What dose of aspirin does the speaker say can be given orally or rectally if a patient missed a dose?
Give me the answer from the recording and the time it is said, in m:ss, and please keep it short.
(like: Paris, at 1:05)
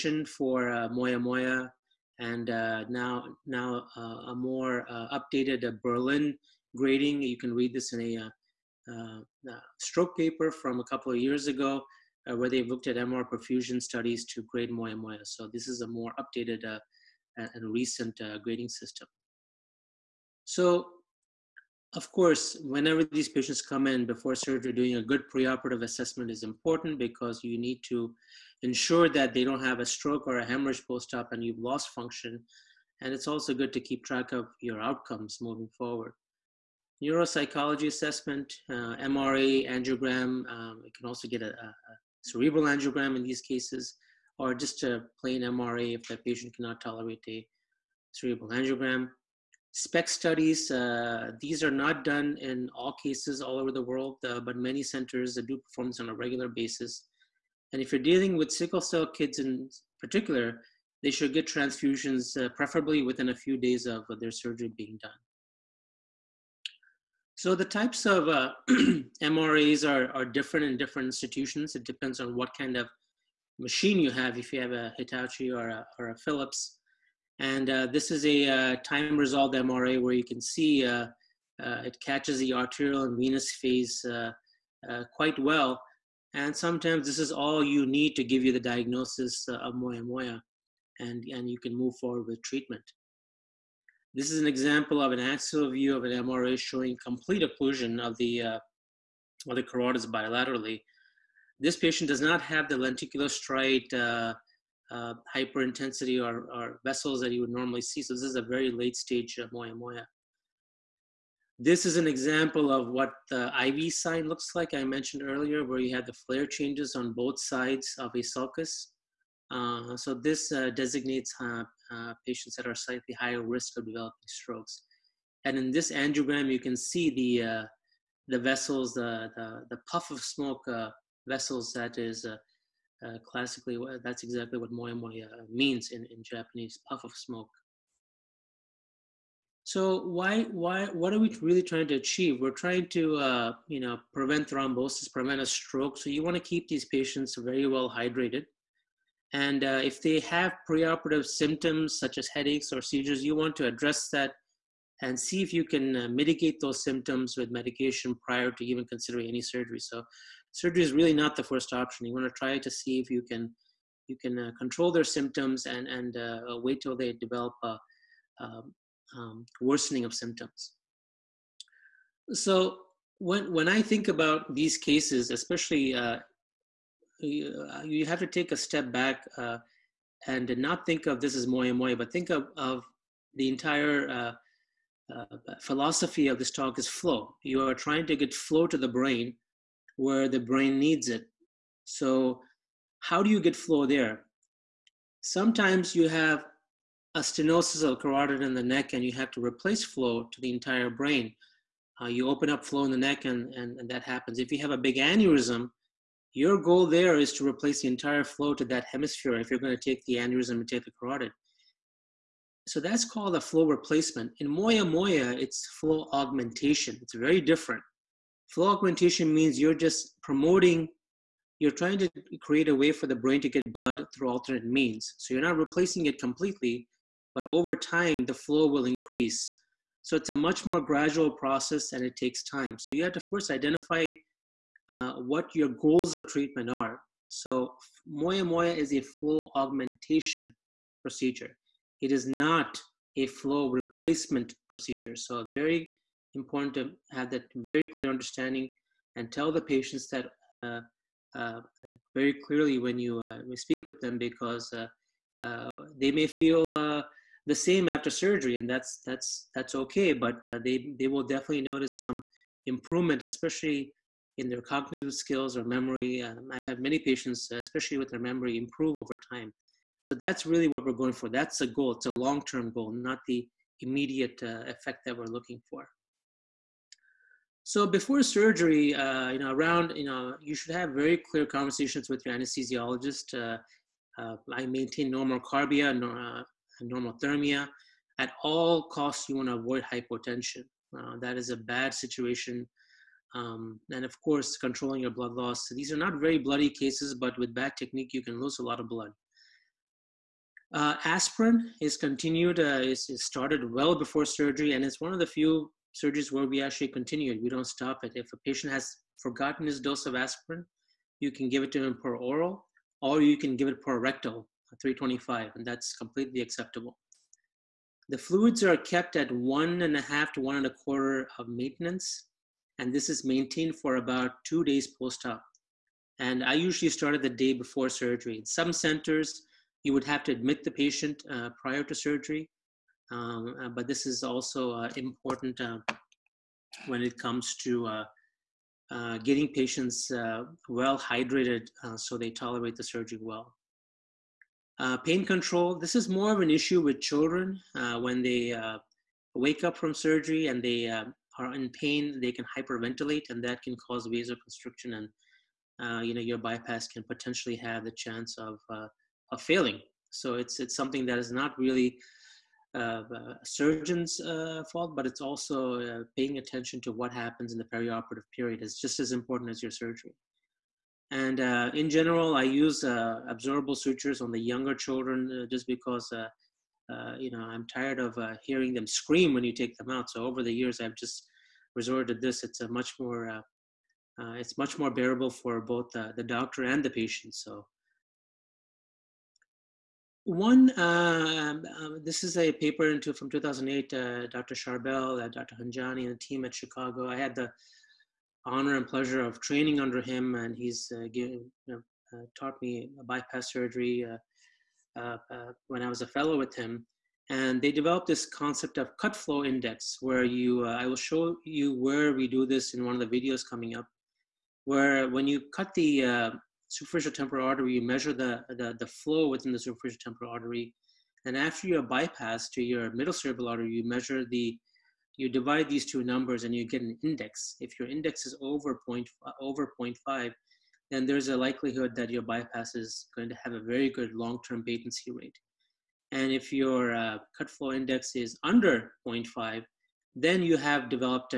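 325, at 5:14.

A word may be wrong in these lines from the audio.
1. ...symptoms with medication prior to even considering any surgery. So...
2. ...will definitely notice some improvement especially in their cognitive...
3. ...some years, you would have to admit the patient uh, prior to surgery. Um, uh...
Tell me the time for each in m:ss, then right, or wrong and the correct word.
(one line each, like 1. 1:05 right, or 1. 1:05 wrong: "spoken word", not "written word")
1. 2:36 right
2. 4:21 right
3. 5:28 wrong: "centers", not "years".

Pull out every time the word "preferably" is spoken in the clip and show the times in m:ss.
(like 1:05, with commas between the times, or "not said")
1:02.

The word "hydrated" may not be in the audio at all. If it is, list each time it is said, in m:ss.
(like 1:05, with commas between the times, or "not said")
2:27, 5:40.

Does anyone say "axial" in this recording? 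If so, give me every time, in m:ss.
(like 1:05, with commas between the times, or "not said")
1:35.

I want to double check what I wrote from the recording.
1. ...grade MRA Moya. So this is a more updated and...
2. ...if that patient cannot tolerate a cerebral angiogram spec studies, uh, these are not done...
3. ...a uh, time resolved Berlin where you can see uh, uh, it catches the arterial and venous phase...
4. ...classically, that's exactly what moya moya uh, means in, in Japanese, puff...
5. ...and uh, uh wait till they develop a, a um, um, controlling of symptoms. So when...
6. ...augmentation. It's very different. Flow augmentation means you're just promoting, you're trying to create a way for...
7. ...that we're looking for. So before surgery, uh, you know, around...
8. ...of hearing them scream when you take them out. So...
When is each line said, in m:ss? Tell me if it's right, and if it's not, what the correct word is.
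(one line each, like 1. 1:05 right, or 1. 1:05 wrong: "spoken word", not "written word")
1. 0:14 wrong: "Moya", not "MRA"
2. 0:45 right
3. 1:18 wrong: "MRA", not "Berlin"
4. 2:13 right
5. 2:45 wrong: "worsening", not "controlling"
6. 3:36 right
7. 4:35 right
8. 6:17 right.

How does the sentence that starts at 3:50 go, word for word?
So it's a much more gradual process and it takes time.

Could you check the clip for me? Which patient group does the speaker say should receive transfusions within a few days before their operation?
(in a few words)
Sickle cell kids.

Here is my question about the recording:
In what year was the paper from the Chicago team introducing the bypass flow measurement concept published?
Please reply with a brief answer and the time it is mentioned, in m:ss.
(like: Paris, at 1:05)
2008, at 6:33.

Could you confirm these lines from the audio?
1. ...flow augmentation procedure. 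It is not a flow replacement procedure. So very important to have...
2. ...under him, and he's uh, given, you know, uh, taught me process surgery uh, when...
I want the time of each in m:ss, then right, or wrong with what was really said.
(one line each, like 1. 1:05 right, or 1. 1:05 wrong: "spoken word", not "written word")
1. 3:59 right
2. 6:39 wrong: "bypass", not "process".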